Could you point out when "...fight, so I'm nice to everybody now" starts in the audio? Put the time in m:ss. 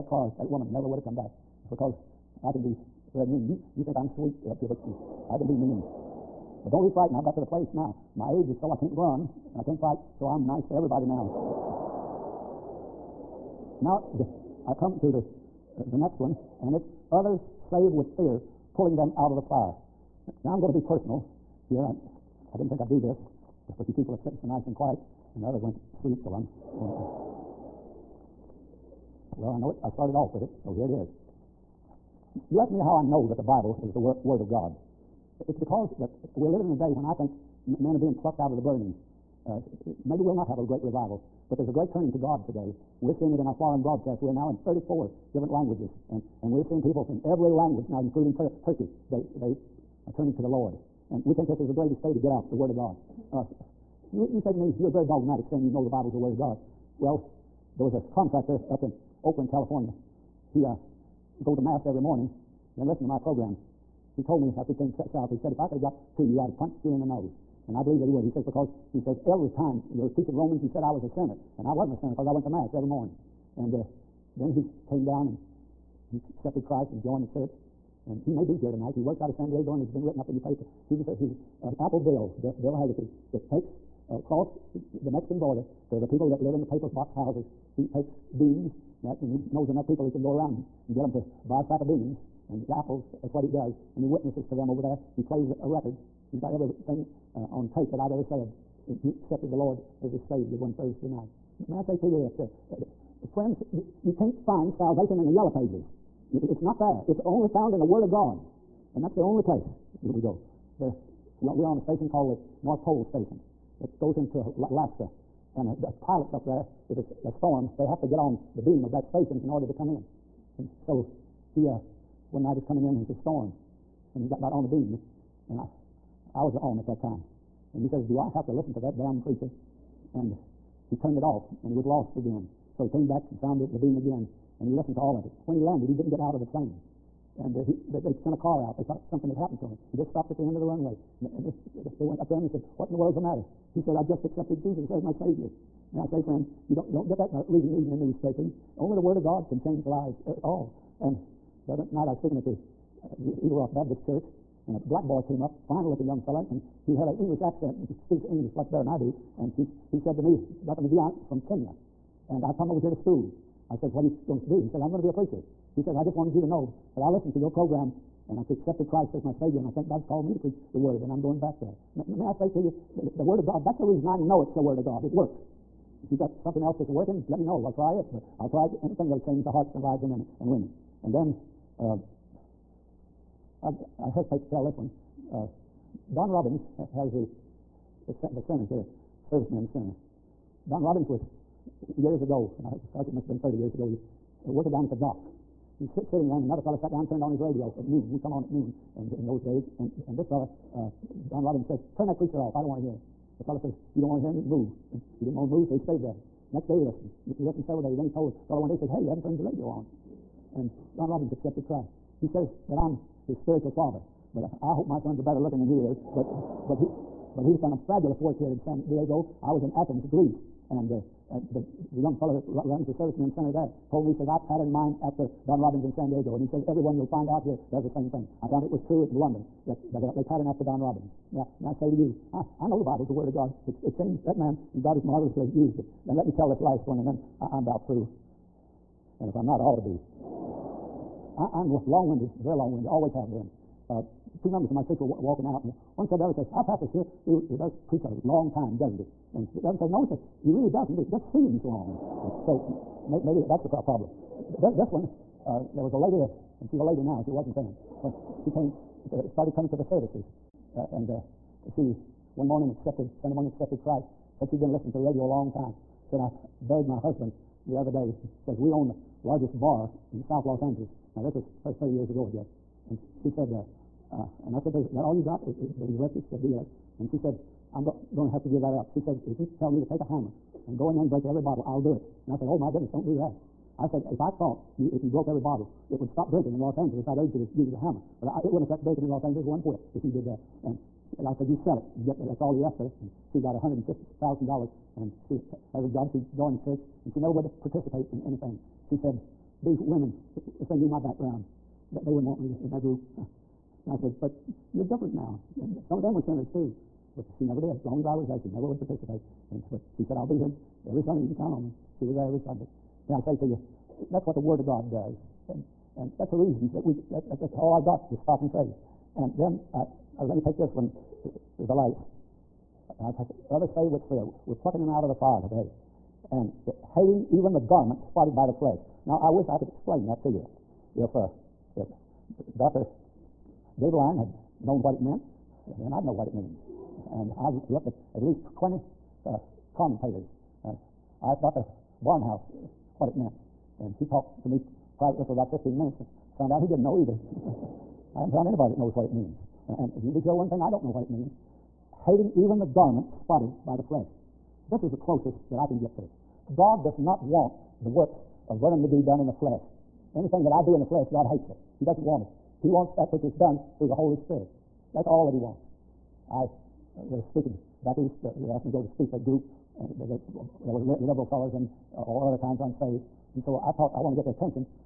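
0:09.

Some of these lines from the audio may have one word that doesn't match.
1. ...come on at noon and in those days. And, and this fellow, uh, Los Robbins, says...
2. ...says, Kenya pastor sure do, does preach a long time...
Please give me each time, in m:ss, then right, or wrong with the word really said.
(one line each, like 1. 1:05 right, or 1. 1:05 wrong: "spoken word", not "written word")
1. 3:18 wrong: "Don", not "Los"
2. 4:06 wrong: "Our", not "Kenya".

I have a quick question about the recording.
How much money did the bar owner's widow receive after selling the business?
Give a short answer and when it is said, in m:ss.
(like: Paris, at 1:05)
$150,000, at 4:53.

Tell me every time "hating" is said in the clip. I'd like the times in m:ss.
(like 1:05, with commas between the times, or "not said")
5:26, 5:51.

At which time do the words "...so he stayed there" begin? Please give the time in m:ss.
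3:25.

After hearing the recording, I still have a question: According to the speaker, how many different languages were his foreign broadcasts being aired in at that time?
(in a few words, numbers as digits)
34.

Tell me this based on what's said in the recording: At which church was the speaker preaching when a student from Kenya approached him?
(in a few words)
Eagle Rock Baptist Church.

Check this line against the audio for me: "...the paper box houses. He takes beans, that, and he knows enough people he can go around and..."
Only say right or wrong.
right.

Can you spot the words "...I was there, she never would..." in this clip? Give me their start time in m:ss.
5:08.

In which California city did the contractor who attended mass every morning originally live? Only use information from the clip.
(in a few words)
Oakland.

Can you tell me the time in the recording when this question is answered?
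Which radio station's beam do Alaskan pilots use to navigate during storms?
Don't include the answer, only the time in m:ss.
1:52.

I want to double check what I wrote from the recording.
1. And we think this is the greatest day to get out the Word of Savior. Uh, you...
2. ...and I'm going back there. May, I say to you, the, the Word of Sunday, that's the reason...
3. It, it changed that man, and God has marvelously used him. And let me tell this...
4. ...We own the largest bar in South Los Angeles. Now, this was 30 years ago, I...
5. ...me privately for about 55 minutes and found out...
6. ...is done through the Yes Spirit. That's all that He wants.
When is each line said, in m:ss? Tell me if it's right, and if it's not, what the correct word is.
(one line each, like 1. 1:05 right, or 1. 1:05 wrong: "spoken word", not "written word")
1. 0:51 wrong: "God", not "Savior"
2. 2:51 wrong: "God", not "Sunday"
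3. 3:53 right
4. 4:28 right
5. 5:44 wrong: "15", not "55"
6. 6:03 wrong: "Holy", not "Yes".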